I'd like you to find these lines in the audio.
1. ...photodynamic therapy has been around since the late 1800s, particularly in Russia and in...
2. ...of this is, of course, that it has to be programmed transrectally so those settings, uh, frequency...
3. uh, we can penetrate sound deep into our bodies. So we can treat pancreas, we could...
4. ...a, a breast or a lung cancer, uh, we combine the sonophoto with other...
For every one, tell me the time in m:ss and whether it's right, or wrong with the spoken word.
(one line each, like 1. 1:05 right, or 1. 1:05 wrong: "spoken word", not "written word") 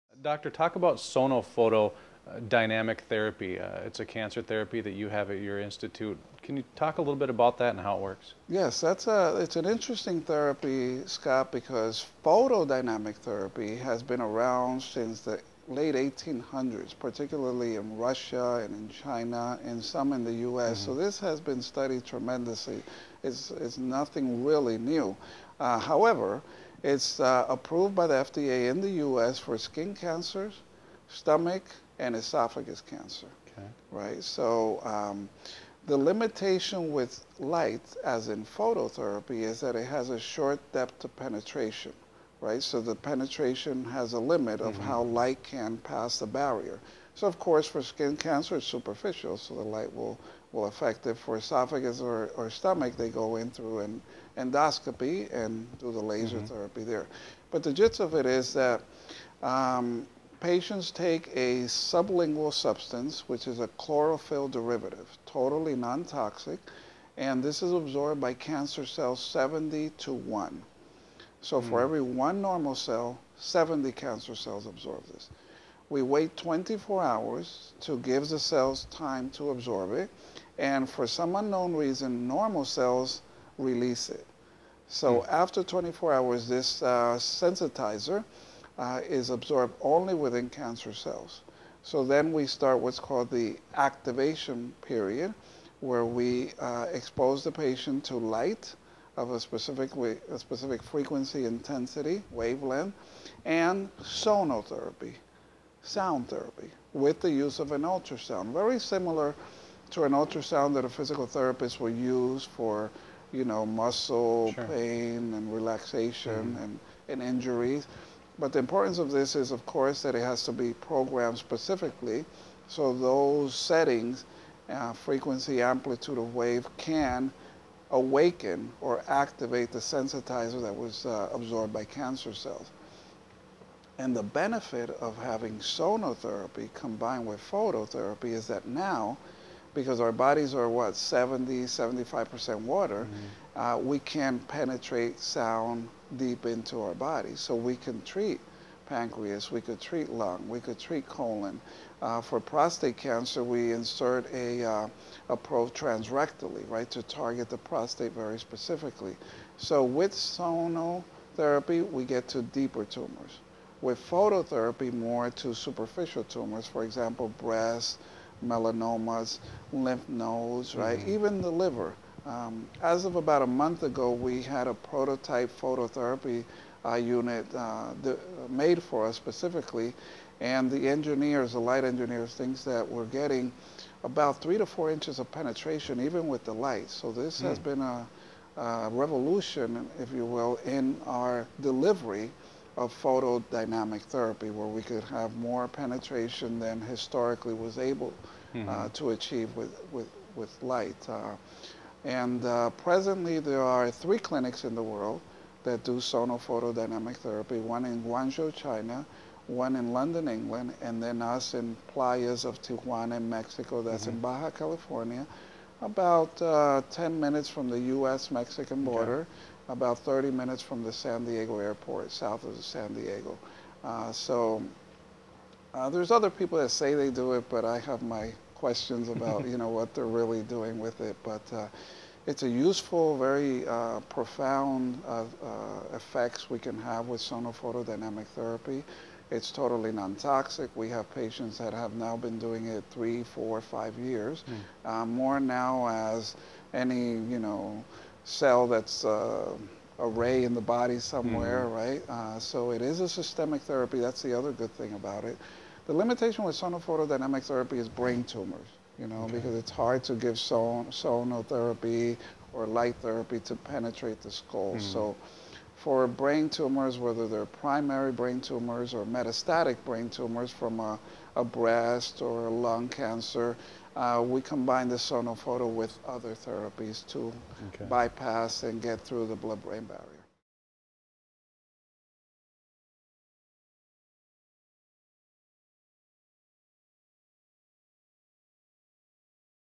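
1. 0:12 right
2. 1:59 wrong: "specifically", not "transrectally"
3. 2:23 right
4. 4:30 right.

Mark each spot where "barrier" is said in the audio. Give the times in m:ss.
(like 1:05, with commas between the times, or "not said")
0:46, 4:39.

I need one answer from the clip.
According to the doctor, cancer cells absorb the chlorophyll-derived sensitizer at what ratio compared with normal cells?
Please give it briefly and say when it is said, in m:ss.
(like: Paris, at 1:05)
70 to 1, at 1:09.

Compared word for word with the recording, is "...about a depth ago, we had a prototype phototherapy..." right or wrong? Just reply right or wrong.
wrong.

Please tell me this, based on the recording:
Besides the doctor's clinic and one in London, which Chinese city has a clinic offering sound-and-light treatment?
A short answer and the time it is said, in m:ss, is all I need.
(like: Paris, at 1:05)
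Guangzhou, at 3:28.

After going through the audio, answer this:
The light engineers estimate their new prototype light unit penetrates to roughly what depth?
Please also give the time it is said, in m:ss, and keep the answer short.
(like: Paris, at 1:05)
3 to 4 inches, at 3:04.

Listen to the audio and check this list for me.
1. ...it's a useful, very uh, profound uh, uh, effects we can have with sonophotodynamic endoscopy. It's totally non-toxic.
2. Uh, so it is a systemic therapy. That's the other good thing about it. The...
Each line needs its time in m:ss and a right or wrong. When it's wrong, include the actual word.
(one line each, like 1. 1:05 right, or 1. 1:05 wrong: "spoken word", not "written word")
1. 3:52 wrong: "therapy", not "endoscopy"
2. 4:12 right.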